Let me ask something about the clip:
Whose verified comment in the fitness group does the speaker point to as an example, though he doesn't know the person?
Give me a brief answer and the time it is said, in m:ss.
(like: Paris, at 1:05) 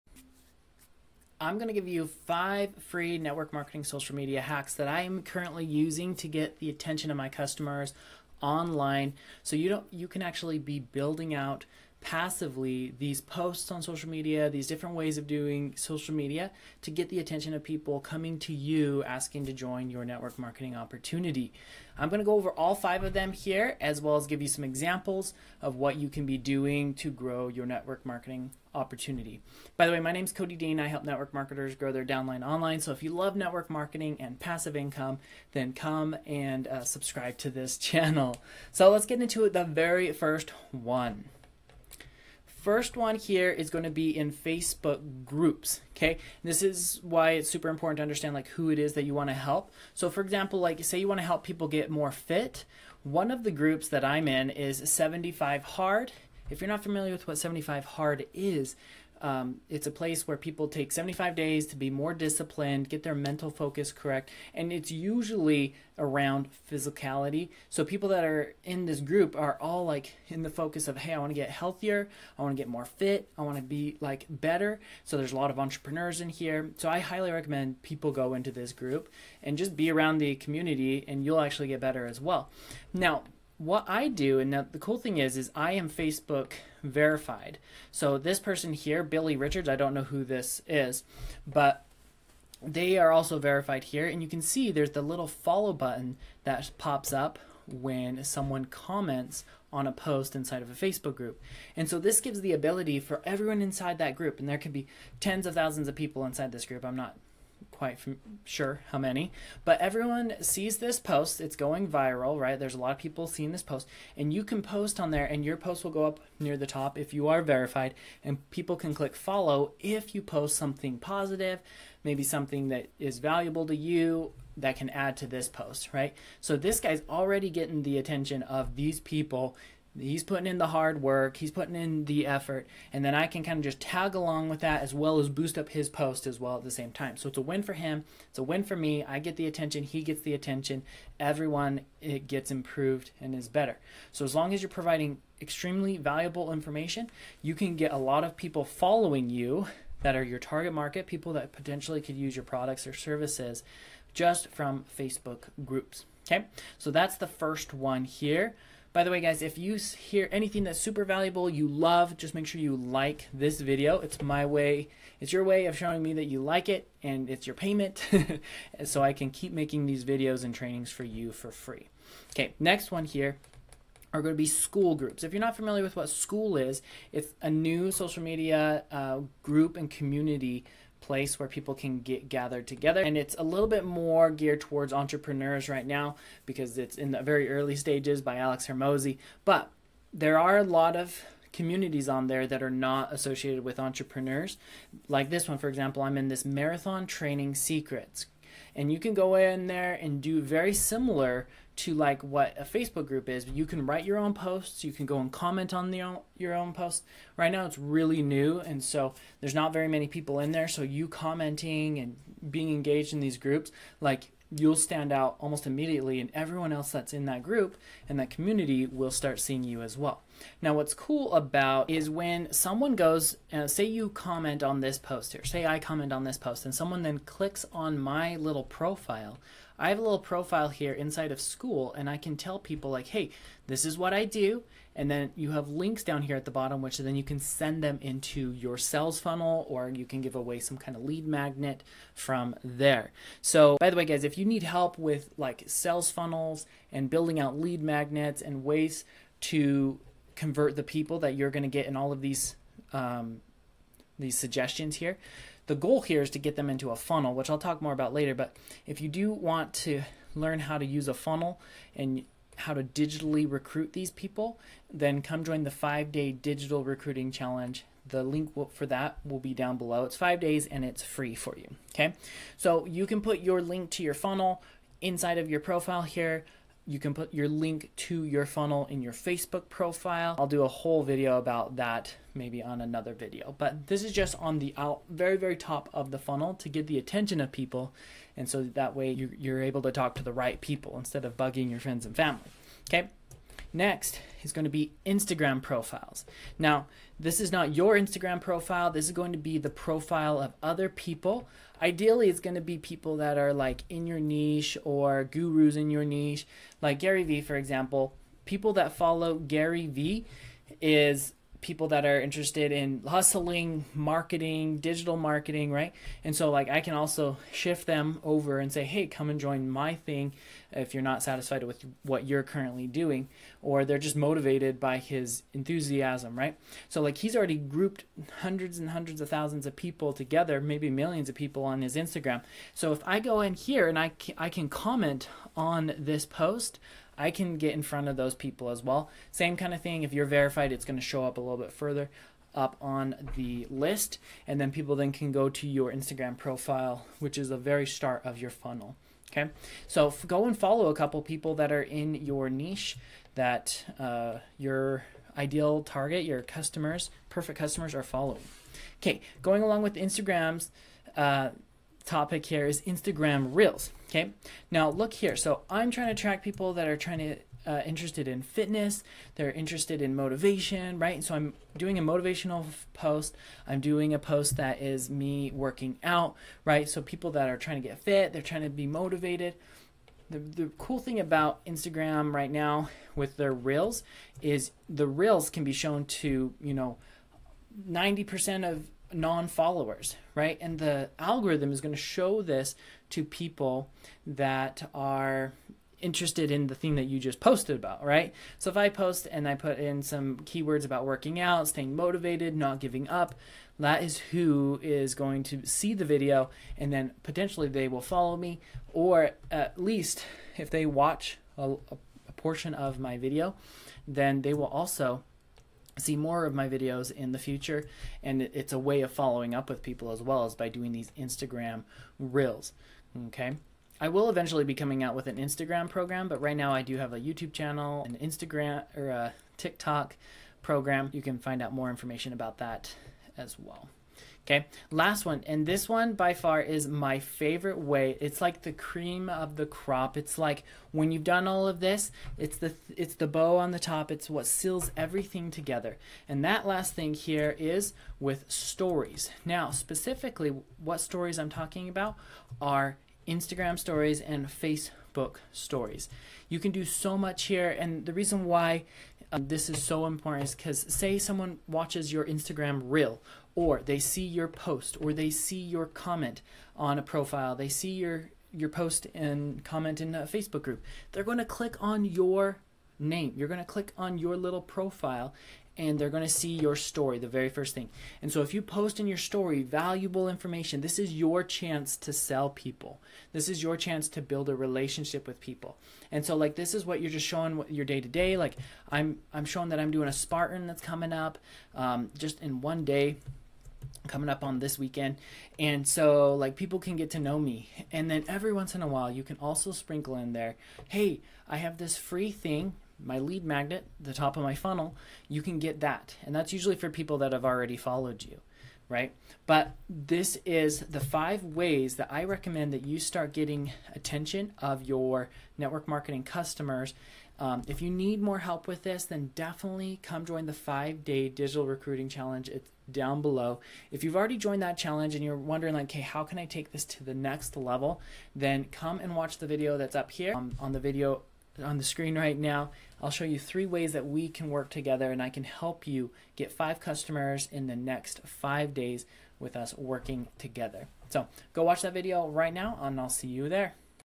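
Billy Richards, at 1:29.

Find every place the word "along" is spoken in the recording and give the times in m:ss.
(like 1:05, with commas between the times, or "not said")
2:14, 5:59.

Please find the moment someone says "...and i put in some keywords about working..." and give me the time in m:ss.
6:39.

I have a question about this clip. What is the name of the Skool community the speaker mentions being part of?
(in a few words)
Marathon Training Secrets.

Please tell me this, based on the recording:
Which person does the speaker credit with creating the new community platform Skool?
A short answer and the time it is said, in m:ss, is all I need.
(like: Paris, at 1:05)
Alex Hormozi, at 3:08.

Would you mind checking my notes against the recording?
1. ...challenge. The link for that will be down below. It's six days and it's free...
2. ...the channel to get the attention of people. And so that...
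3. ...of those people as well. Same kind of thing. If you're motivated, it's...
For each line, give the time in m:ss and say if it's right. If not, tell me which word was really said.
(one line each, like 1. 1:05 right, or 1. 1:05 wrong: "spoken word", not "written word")
1. 4:27 wrong: "five", not "six"
2. 4:46 wrong: "funnel", not "channel"
3. 5:38 wrong: "verified", not "motivated".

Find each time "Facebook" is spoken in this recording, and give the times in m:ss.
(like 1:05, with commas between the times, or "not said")
0:44, 1:25, 1:40, 2:34, 3:22, 4:39, 7:34, 7:50.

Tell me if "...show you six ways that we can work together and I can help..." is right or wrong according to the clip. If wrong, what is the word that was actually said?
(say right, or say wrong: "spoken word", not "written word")
wrong: "three", not "six".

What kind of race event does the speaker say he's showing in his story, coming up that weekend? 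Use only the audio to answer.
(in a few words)
A Spartan.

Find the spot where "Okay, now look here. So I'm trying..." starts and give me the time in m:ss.
6:04.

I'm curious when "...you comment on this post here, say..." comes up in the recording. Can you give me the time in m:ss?
3:43.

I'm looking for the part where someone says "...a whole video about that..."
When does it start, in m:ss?
4:40.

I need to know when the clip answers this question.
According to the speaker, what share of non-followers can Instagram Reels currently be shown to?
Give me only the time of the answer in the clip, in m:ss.
6:27.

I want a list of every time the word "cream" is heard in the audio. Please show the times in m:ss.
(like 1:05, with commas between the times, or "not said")
7:18.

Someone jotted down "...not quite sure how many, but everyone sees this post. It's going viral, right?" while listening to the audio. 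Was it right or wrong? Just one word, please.
right.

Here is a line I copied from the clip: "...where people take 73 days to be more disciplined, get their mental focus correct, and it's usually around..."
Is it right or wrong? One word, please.
wrong.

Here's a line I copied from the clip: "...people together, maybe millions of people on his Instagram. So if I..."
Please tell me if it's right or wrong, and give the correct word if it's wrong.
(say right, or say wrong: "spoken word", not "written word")
right.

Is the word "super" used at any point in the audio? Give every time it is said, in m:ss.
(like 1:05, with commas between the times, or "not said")
0:47, 2:40.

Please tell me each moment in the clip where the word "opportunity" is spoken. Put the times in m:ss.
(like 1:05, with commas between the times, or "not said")
0:20, 0:28.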